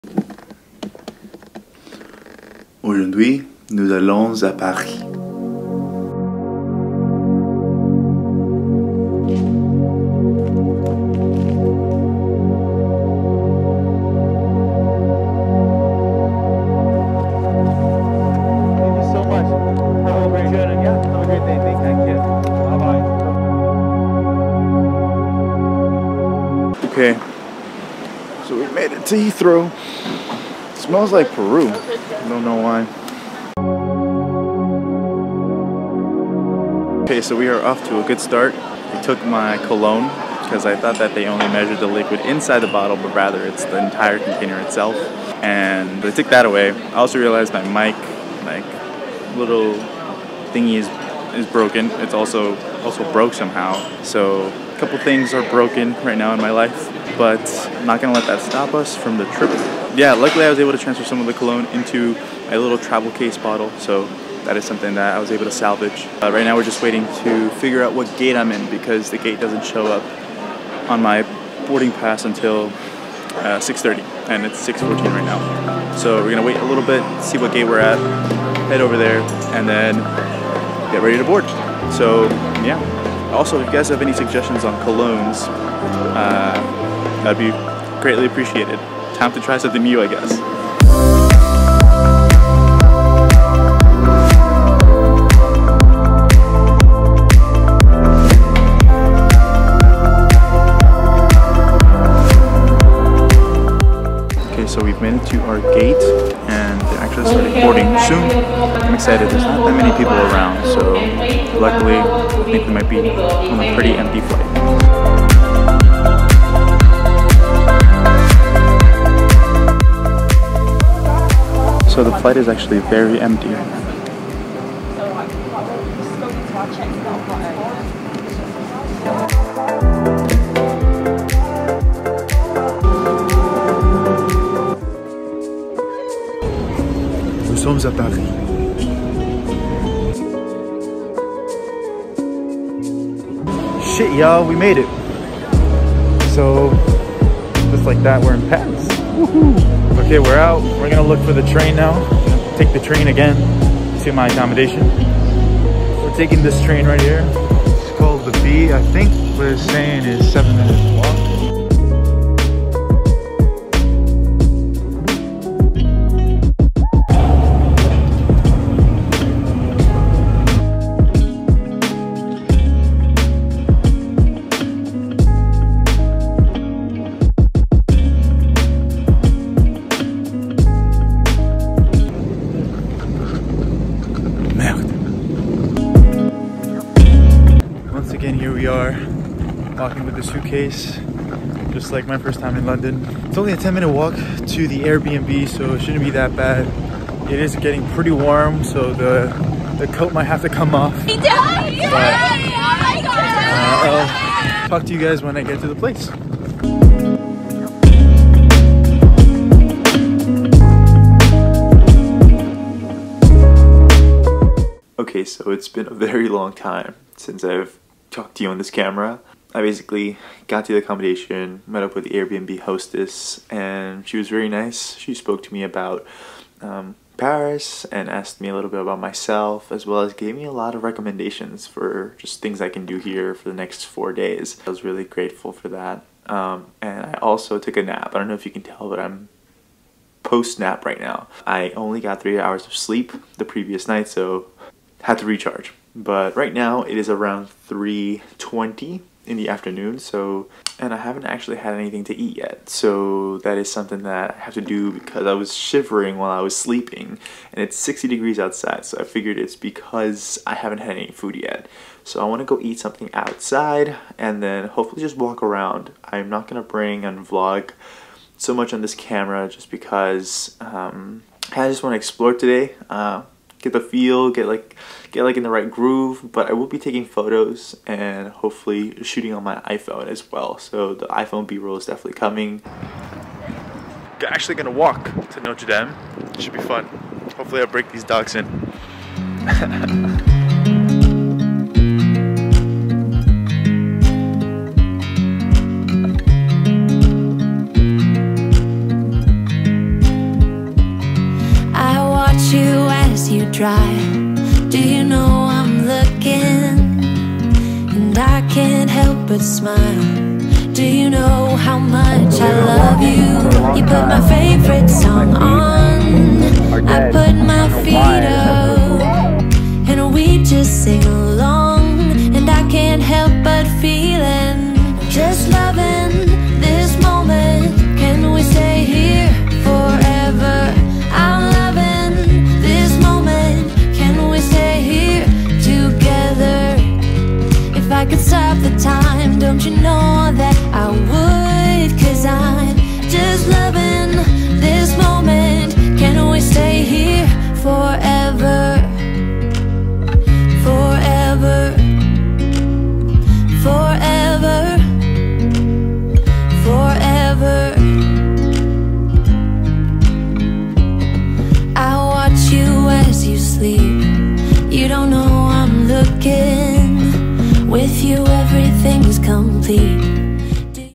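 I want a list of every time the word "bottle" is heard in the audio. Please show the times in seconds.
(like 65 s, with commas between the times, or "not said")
42 s, 63 s.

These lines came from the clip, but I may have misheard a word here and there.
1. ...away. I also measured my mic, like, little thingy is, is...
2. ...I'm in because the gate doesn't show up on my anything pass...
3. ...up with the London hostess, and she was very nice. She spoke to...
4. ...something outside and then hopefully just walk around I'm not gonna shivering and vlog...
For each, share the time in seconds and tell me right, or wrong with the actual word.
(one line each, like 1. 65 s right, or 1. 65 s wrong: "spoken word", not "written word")
1. 46 s wrong: "realized", not "measured"
2. 68 s wrong: "boarding", not "anything"
3. 221 s wrong: "Airbnb", not "London"
4. 262 s wrong: "bring", not "shivering".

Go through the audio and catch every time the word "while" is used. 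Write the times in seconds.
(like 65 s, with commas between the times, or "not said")
256 s.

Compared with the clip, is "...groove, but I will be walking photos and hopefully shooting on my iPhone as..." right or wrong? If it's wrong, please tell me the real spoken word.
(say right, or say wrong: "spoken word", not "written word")
wrong: "taking", not "walking".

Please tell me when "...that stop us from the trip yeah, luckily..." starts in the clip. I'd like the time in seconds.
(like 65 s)
58 s.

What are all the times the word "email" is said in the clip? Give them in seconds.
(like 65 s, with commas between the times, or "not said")
not said.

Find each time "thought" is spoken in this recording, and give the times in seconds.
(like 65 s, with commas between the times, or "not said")
40 s.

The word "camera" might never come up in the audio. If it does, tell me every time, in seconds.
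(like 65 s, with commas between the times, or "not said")
218 s, 268 s.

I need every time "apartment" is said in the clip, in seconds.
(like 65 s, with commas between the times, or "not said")
not said.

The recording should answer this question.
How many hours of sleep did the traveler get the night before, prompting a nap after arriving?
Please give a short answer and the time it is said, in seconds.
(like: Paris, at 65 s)
3, at 242 s.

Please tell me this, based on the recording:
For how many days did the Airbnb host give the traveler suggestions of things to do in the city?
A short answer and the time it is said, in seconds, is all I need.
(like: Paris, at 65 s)
4, at 233 s.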